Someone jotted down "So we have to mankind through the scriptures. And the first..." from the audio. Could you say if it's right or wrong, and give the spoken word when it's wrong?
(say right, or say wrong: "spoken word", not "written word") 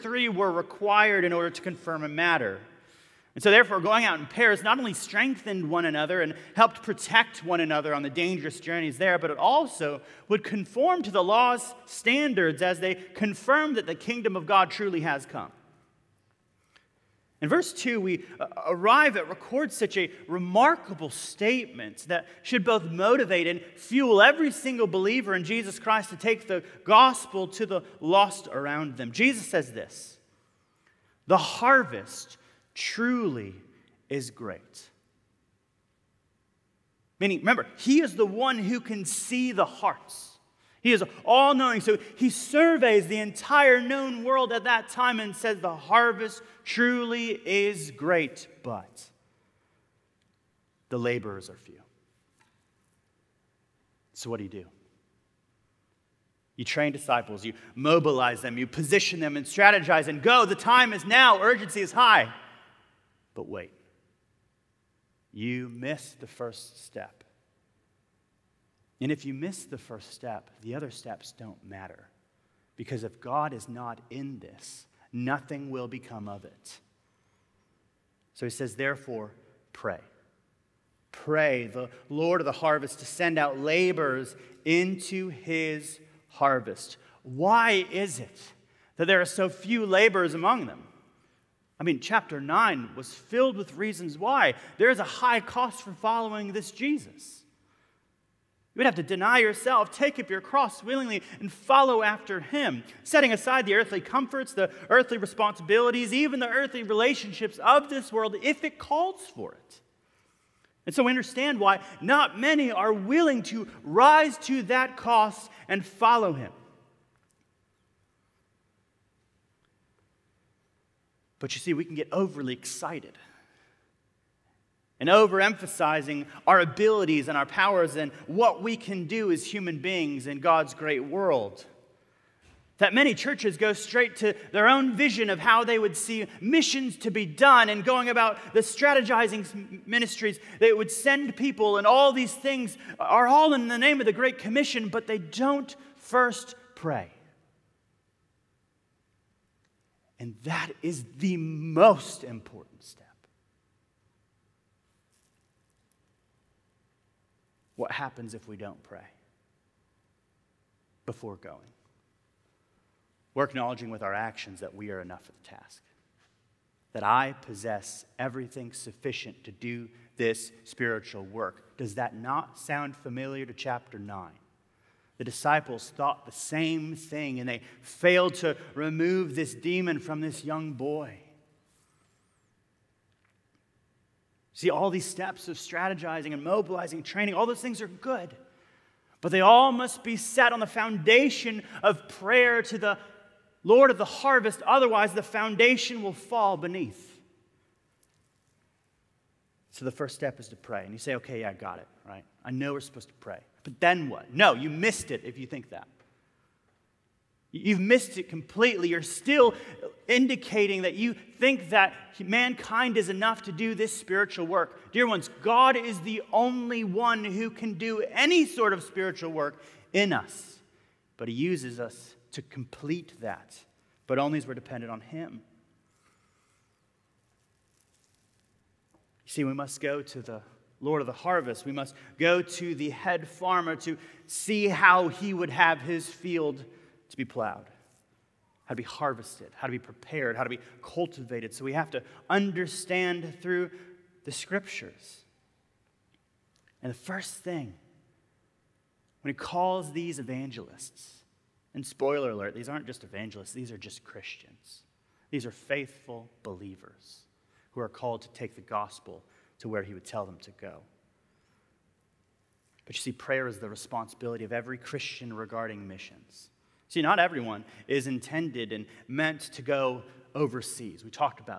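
wrong: "understand", not "mankind".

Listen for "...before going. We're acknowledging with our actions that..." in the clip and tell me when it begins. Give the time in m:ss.
2:41.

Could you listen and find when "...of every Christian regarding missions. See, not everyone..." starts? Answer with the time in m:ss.
4:24.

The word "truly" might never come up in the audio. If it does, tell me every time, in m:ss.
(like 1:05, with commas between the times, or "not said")
0:14, 0:32, 0:46.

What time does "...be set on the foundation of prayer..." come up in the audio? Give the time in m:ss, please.
3:10.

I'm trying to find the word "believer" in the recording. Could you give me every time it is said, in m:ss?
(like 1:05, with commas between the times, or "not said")
0:24, 4:16.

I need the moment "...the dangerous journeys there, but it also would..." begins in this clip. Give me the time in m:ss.
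0:08.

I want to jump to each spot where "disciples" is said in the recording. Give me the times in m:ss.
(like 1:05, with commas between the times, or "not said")
0:56, 2:55.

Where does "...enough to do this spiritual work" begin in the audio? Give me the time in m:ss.
3:33.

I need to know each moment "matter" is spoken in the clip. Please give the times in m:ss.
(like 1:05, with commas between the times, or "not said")
0:02, 1:11.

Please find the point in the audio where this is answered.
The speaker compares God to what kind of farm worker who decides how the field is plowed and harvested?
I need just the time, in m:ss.
3:52.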